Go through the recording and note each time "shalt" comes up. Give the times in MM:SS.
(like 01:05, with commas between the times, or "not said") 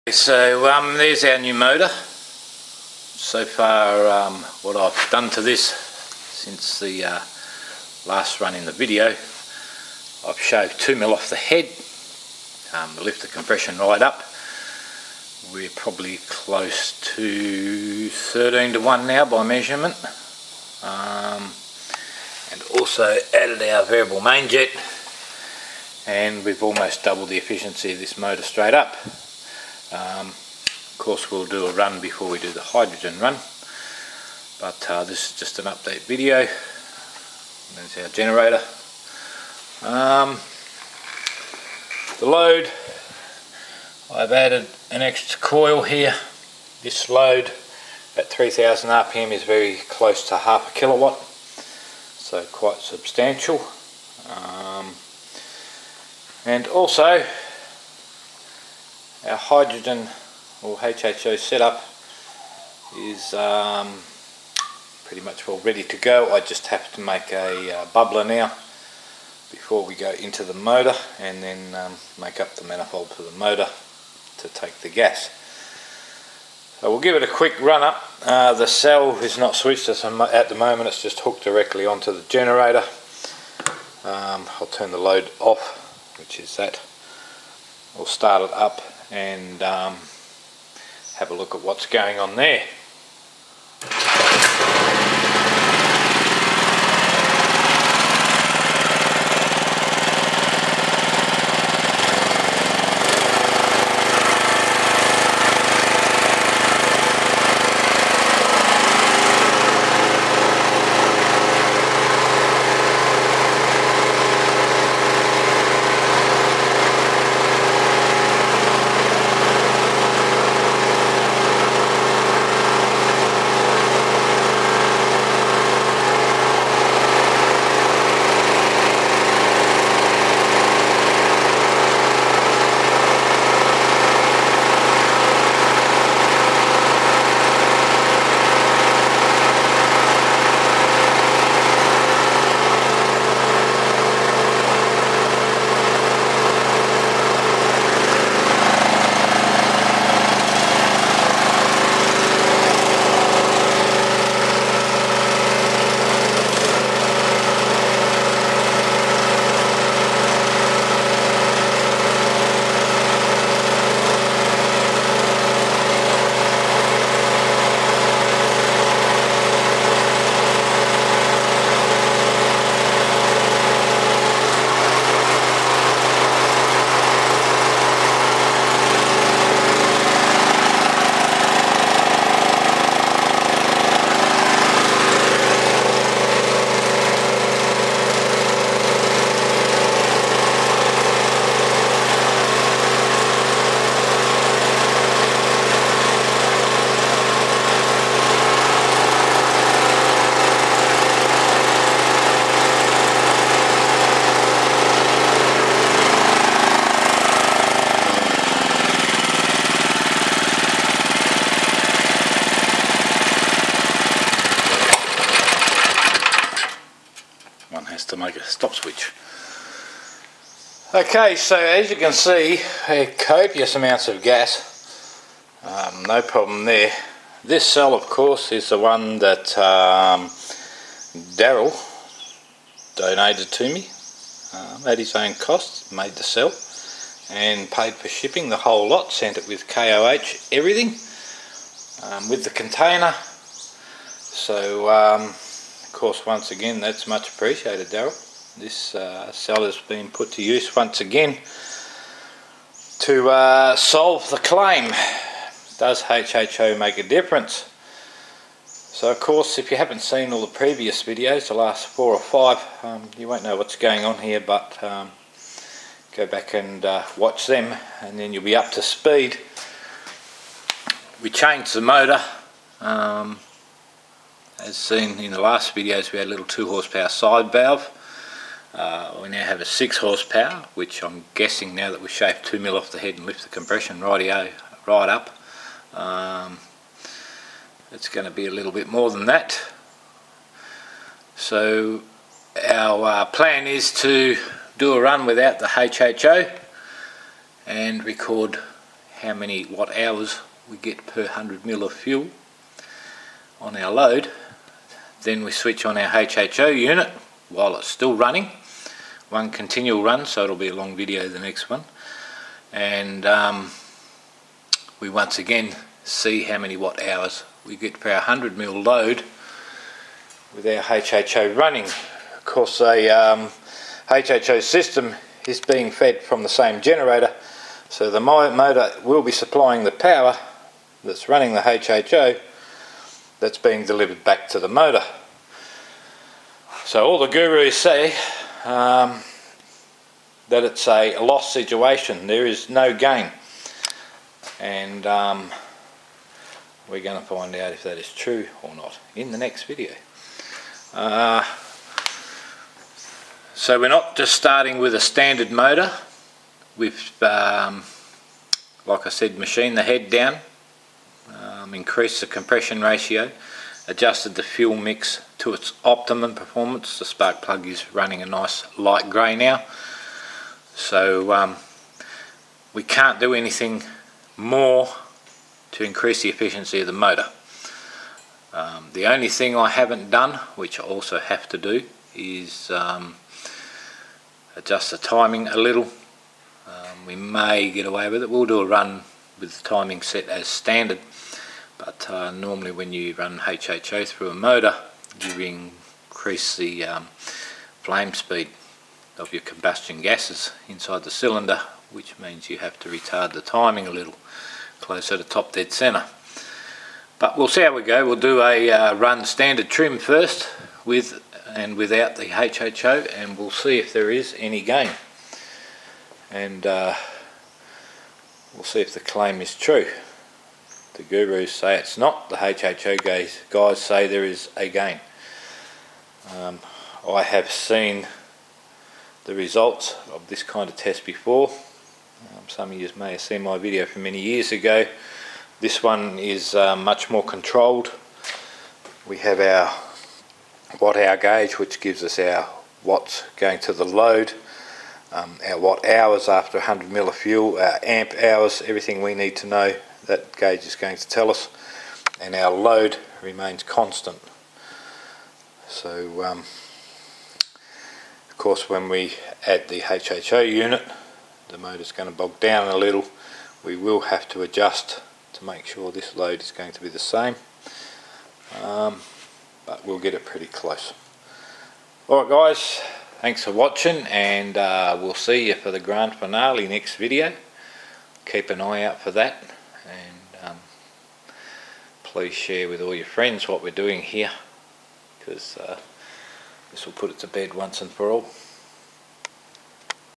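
not said.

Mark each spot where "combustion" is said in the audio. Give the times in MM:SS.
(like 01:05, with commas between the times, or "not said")
06:39.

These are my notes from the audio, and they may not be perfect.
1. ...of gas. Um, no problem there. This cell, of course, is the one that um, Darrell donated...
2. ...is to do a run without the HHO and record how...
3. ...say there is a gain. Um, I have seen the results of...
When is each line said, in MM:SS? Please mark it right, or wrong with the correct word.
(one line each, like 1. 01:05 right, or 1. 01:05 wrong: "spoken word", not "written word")
1. 03:44 right
2. 04:53 right
3. 07:03 right.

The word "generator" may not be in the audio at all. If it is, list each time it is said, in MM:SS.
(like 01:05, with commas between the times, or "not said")
00:38, 01:22, 05:26.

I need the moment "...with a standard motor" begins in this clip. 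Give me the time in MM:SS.
05:54.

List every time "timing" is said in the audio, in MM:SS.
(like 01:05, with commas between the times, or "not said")
06:24, 06:29, 06:43.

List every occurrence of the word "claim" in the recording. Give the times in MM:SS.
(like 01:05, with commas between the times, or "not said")
04:14, 06:58.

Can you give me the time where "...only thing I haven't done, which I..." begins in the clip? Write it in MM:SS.
06:19.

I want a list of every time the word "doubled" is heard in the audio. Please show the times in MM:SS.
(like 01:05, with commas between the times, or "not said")
00:27.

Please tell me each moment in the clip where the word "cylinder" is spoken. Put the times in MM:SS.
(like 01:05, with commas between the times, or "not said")
06:41.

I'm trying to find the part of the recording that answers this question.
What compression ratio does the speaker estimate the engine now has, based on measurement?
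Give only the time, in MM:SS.
00:18.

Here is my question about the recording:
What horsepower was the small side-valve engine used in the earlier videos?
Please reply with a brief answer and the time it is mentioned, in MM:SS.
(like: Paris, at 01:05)
2 horsepower, at 04:36.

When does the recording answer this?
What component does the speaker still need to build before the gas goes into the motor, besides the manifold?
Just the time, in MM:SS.
01:07.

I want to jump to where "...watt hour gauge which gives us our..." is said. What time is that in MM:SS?
07:20.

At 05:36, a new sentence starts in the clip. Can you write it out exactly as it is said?
So all the gurus say um, that it's a loss situation.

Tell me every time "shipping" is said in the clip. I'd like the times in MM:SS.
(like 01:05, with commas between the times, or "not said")
03:58.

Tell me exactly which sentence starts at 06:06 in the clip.
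The spark plug is running a nice light grey now.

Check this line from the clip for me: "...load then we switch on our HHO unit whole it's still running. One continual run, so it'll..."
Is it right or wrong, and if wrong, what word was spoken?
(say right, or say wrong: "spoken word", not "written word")
wrong: "while", not "whole".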